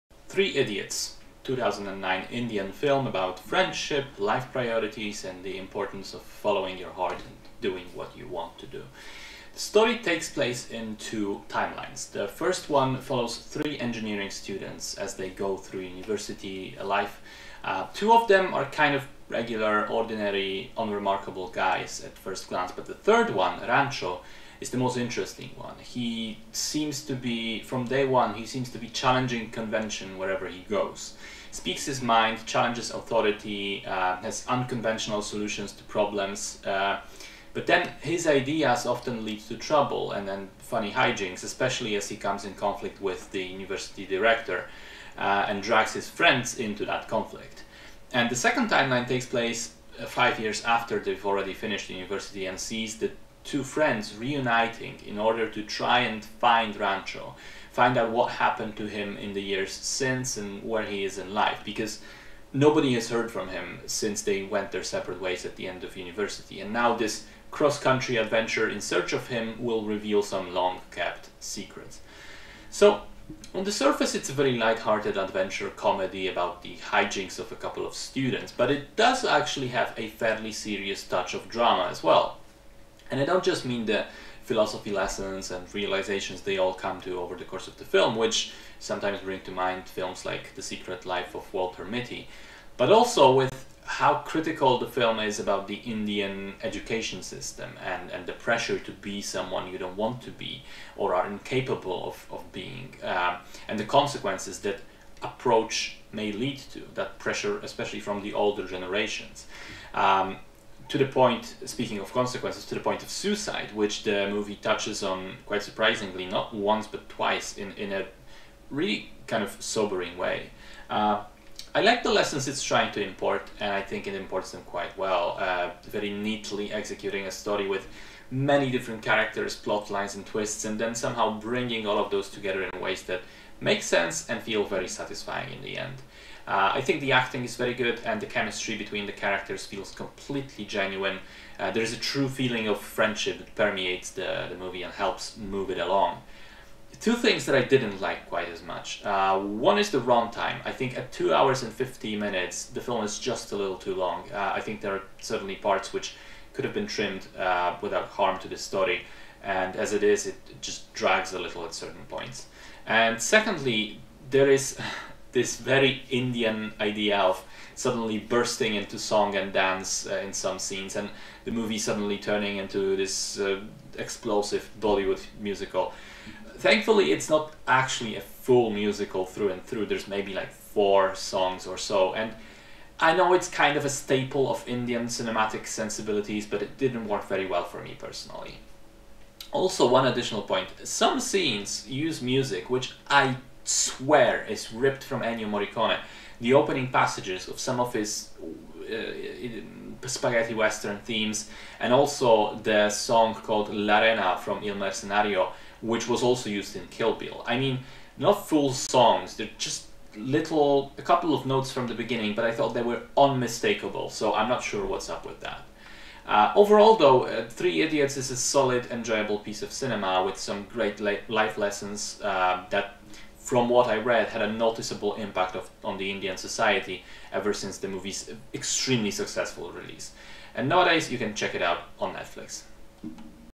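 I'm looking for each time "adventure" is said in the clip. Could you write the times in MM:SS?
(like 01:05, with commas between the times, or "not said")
01:08, 01:15.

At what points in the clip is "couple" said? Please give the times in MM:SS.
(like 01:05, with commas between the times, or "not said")
01:17, 03:31.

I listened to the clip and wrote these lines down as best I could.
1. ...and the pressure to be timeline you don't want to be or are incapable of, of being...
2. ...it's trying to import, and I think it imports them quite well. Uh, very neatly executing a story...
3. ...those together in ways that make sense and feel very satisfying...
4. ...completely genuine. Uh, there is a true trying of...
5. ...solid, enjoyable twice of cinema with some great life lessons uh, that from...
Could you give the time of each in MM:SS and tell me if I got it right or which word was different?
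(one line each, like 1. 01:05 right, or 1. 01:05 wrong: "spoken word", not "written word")
1. 01:38 wrong: "someone", not "timeline"
2. 02:02 right
3. 02:12 right
4. 02:19 wrong: "feeling", not "trying"
5. 03:38 wrong: "piece", not "twice".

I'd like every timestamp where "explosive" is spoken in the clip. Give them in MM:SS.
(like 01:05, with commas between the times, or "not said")
02:53.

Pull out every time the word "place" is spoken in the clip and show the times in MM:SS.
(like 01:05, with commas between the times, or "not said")
00:10, 00:49.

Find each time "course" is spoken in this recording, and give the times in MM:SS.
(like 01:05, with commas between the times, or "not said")
01:27.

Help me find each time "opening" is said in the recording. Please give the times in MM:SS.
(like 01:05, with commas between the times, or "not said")
03:16.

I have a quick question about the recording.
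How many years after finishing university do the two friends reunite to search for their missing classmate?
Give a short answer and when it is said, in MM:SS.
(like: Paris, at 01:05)
5, at 00:50.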